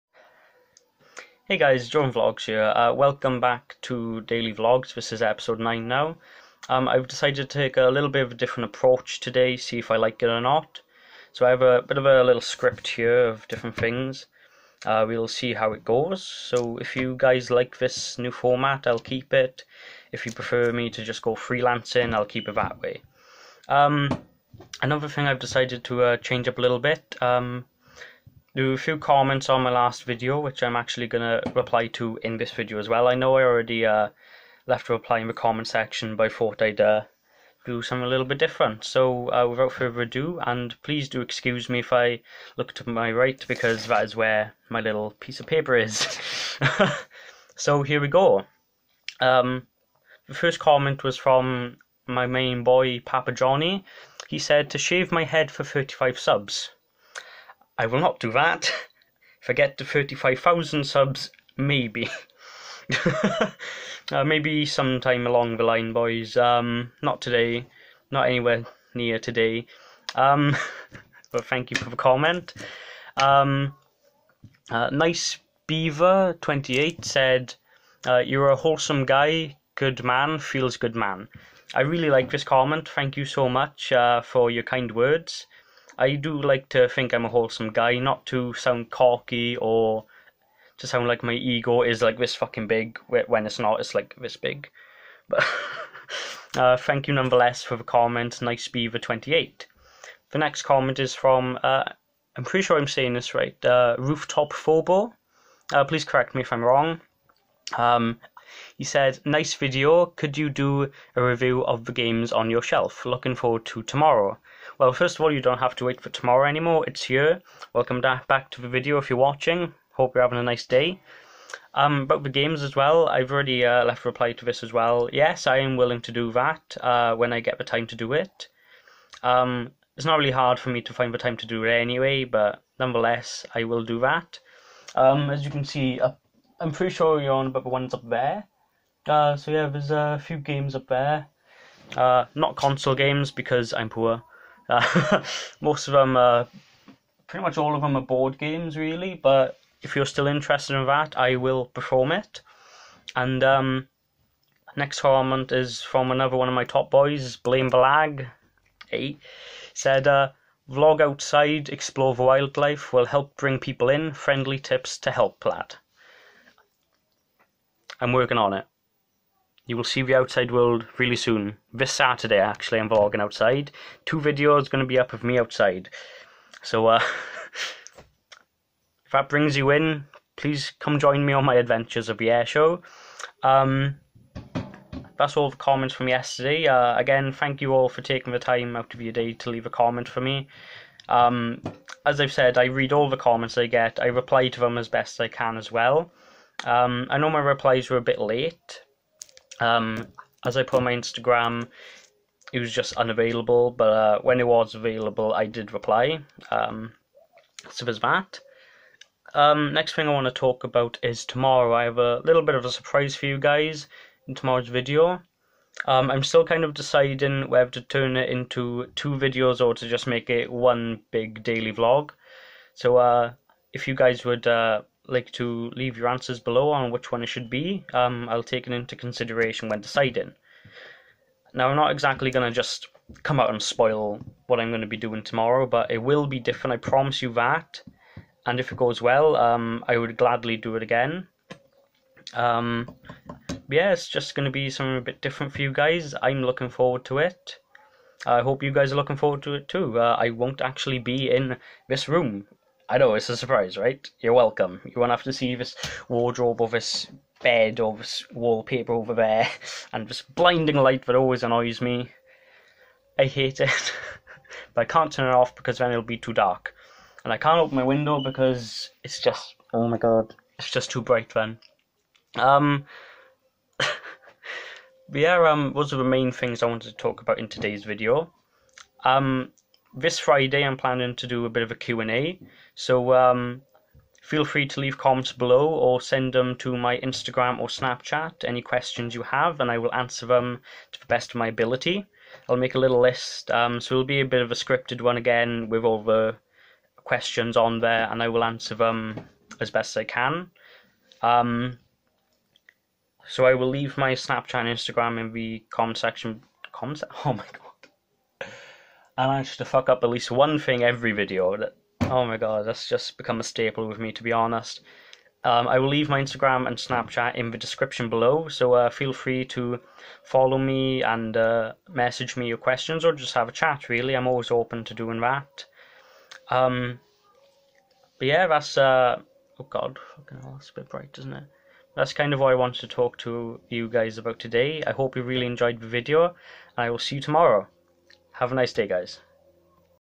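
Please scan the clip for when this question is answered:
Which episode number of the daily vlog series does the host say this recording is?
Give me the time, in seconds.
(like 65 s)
5 s.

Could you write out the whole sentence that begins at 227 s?
Um, I'll take it into consideration when deciding.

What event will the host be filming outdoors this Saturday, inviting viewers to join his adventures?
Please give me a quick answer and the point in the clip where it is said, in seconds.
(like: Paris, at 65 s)
the air show, at 182 s.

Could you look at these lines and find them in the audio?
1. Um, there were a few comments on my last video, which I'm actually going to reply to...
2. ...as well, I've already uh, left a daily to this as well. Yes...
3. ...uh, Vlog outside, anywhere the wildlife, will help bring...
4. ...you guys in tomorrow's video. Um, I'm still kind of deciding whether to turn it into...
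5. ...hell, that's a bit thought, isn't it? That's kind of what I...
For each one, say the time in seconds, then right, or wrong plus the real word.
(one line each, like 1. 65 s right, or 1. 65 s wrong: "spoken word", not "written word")
1. 27 s right
2. 122 s wrong: "reply", not "daily"
3. 160 s wrong: "explore", not "anywhere"
4. 213 s right
5. 330 s wrong: "bright", not "thought".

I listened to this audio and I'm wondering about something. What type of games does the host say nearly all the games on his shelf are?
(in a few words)
board games.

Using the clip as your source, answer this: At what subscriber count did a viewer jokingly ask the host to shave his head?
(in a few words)
35.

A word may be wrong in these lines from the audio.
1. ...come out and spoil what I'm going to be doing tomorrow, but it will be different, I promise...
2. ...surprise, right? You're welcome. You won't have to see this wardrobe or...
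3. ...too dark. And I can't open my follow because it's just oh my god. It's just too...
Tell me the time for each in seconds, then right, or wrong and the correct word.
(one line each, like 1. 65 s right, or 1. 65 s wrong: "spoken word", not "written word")
1. 233 s right
2. 253 s right
3. 266 s wrong: "window", not "follow".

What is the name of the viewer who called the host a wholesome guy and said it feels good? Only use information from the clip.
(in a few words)
Nice Beaver 28.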